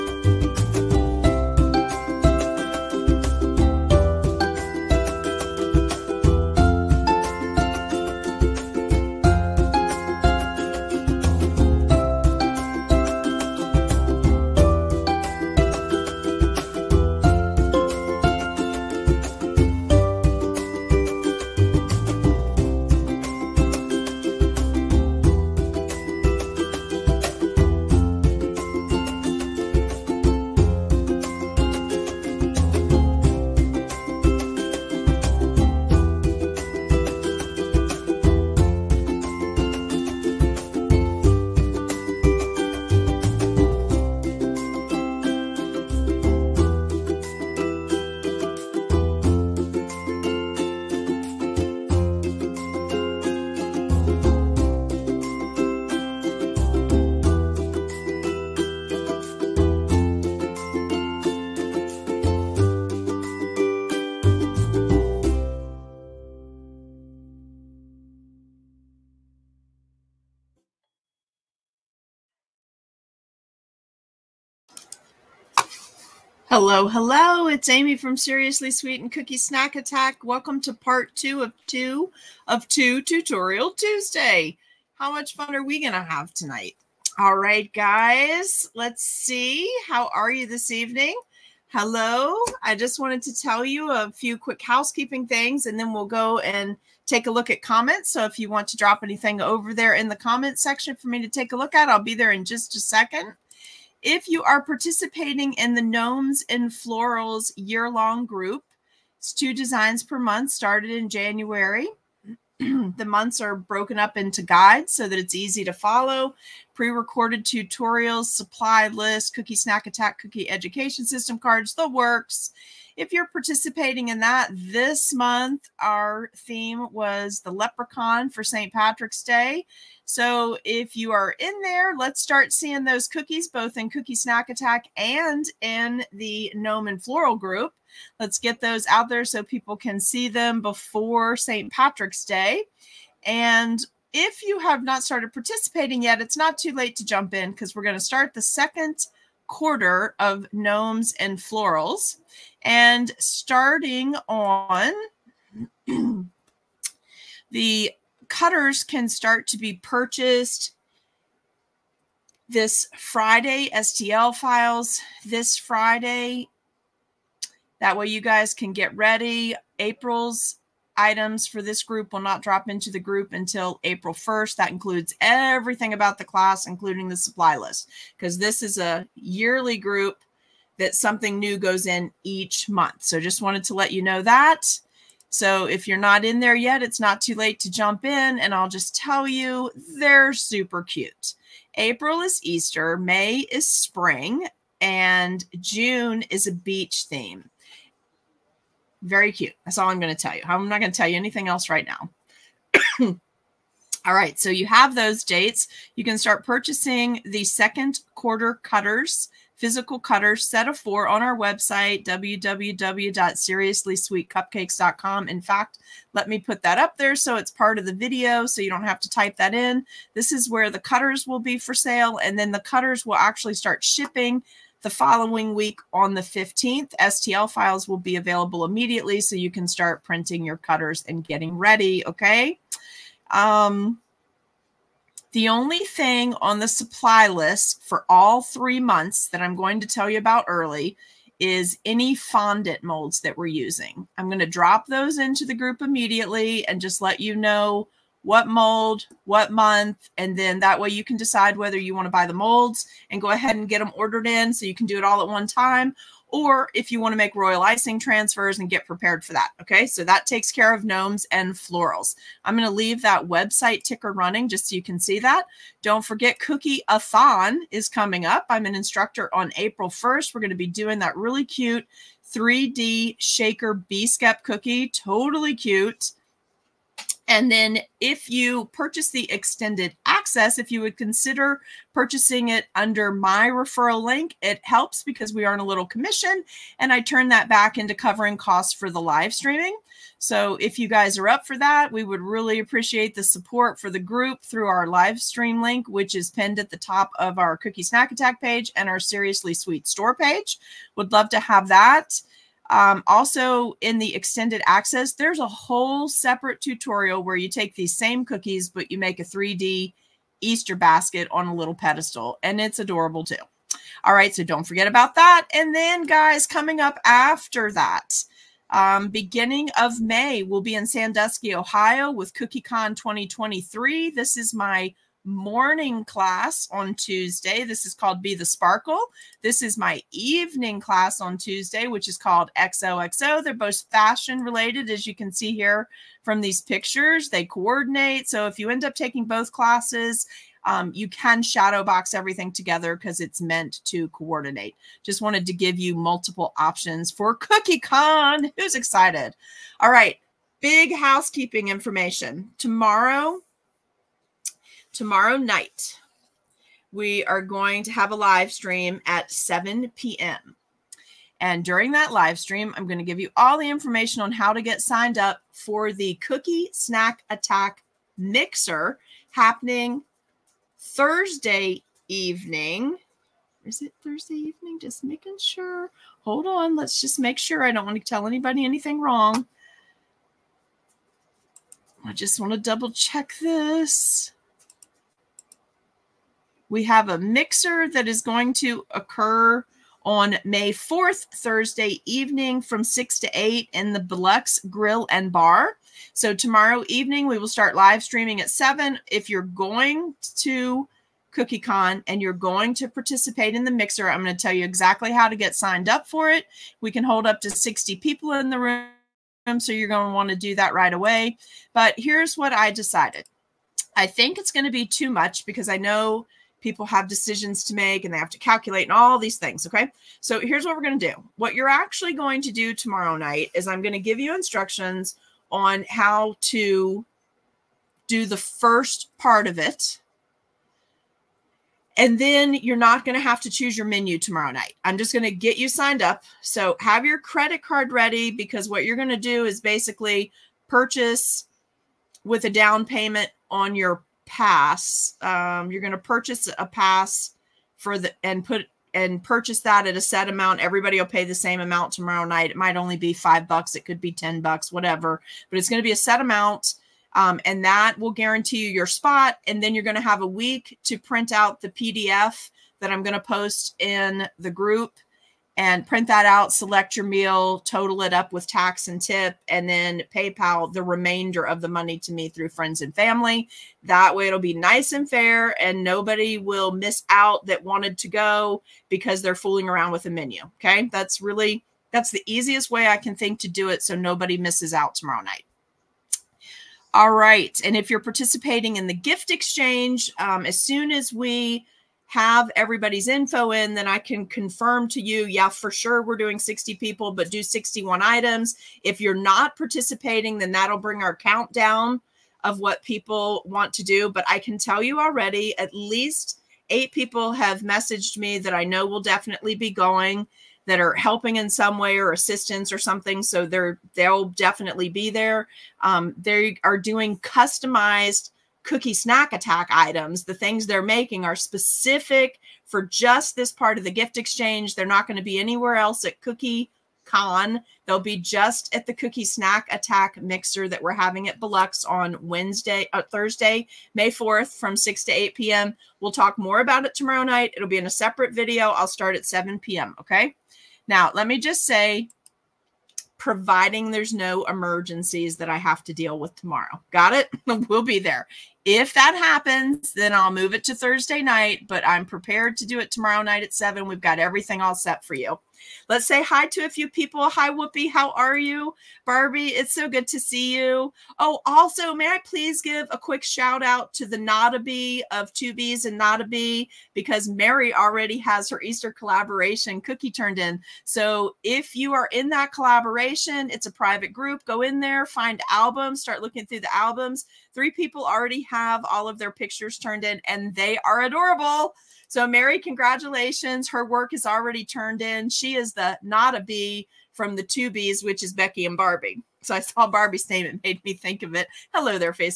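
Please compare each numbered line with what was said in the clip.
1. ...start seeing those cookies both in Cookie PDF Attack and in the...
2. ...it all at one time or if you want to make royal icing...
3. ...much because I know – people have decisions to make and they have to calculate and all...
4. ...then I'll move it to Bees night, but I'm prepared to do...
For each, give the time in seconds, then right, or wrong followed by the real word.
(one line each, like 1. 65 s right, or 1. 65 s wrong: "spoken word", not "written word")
1. 132 s wrong: "Snack", not "PDF"
2. 254 s right
3. 415 s right
4. 549 s wrong: "Thursday", not "Bees".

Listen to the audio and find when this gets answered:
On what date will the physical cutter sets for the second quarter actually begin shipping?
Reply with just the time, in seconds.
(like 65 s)
226 s.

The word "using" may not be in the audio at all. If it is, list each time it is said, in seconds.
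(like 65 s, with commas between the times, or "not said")
243 s.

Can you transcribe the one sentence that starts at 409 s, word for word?
So you're going to want to do that right away.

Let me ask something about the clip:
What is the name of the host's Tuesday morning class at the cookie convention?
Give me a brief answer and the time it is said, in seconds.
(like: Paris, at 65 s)
Be the Sparkle, at 328 s.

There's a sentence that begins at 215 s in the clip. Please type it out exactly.
In fact, let me put that up there so it's part of the video so you don't have to type that in.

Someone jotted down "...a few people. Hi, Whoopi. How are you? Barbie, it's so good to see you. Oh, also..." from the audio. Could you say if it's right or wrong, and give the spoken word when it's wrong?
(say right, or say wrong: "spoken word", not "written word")
right.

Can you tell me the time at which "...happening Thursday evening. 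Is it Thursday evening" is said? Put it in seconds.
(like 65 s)
369 s.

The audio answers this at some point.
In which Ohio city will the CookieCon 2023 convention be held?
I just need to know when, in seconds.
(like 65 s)
320 s.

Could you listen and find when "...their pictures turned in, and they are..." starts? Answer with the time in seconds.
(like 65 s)
579 s.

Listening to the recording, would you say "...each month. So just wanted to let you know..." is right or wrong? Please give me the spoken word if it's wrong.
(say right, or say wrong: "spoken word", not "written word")
right.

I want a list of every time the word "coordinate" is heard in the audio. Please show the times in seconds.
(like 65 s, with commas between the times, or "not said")
337 s, 344 s.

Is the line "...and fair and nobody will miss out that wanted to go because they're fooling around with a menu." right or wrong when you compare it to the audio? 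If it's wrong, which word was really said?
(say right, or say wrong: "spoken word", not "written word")
right.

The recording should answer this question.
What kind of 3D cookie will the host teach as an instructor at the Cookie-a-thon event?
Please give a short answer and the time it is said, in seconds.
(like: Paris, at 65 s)
3D shaker bee skep, at 272 s.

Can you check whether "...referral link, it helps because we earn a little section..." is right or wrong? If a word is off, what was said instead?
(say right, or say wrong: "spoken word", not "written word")
wrong: "commission", not "section".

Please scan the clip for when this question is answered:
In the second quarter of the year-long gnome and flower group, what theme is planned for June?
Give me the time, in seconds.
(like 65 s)
196 s.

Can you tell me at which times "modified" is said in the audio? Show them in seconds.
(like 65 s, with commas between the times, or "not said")
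not said.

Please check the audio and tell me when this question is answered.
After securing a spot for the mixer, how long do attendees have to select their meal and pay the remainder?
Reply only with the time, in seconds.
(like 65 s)
460 s.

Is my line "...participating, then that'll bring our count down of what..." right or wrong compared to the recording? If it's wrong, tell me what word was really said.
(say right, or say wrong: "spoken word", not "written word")
right.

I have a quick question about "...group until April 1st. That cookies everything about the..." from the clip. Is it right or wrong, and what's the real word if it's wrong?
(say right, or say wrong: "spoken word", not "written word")
wrong: "includes", not "cookies".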